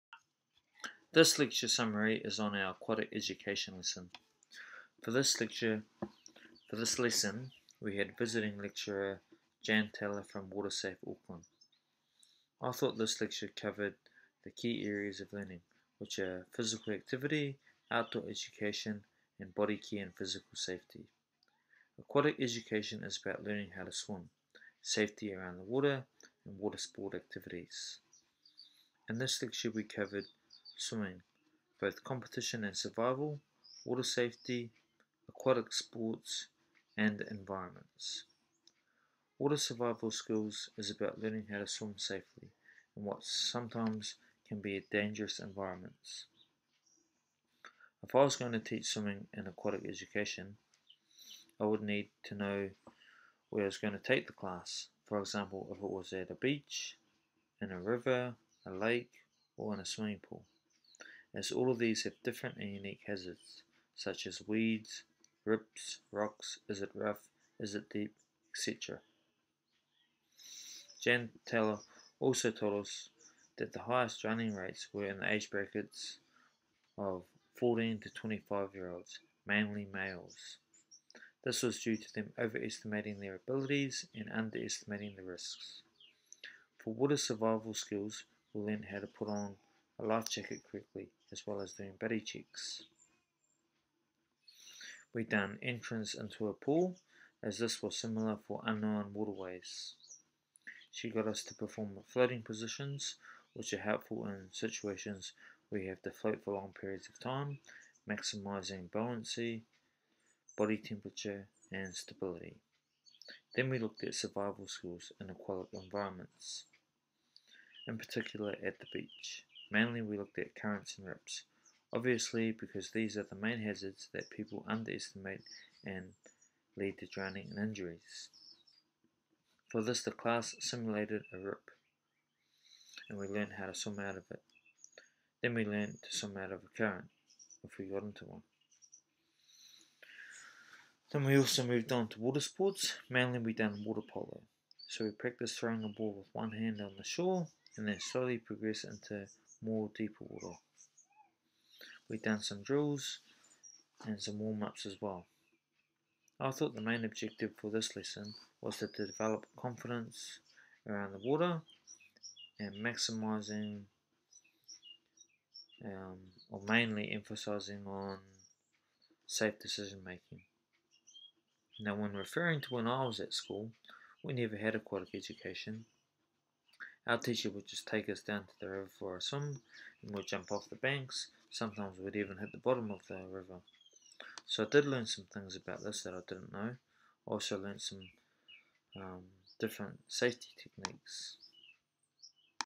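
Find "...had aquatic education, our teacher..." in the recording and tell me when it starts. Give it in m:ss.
2:54.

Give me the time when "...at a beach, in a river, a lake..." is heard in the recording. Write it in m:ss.
0:56.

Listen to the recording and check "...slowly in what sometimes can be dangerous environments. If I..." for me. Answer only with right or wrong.
wrong.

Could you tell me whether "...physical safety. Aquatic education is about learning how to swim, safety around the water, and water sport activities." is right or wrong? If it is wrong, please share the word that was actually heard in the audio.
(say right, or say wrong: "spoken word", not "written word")
right.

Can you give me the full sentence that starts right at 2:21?
Then we also moved on to water sports.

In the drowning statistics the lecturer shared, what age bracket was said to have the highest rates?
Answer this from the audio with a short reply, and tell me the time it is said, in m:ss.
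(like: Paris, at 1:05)
14 to 25, at 1:17.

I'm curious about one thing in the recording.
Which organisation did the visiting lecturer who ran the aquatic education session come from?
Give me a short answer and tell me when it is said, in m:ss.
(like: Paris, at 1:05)
WaterSafe Auckland, at 0:10.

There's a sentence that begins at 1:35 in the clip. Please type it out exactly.
We've done entrance into a pool as this was similar for unknown waterways.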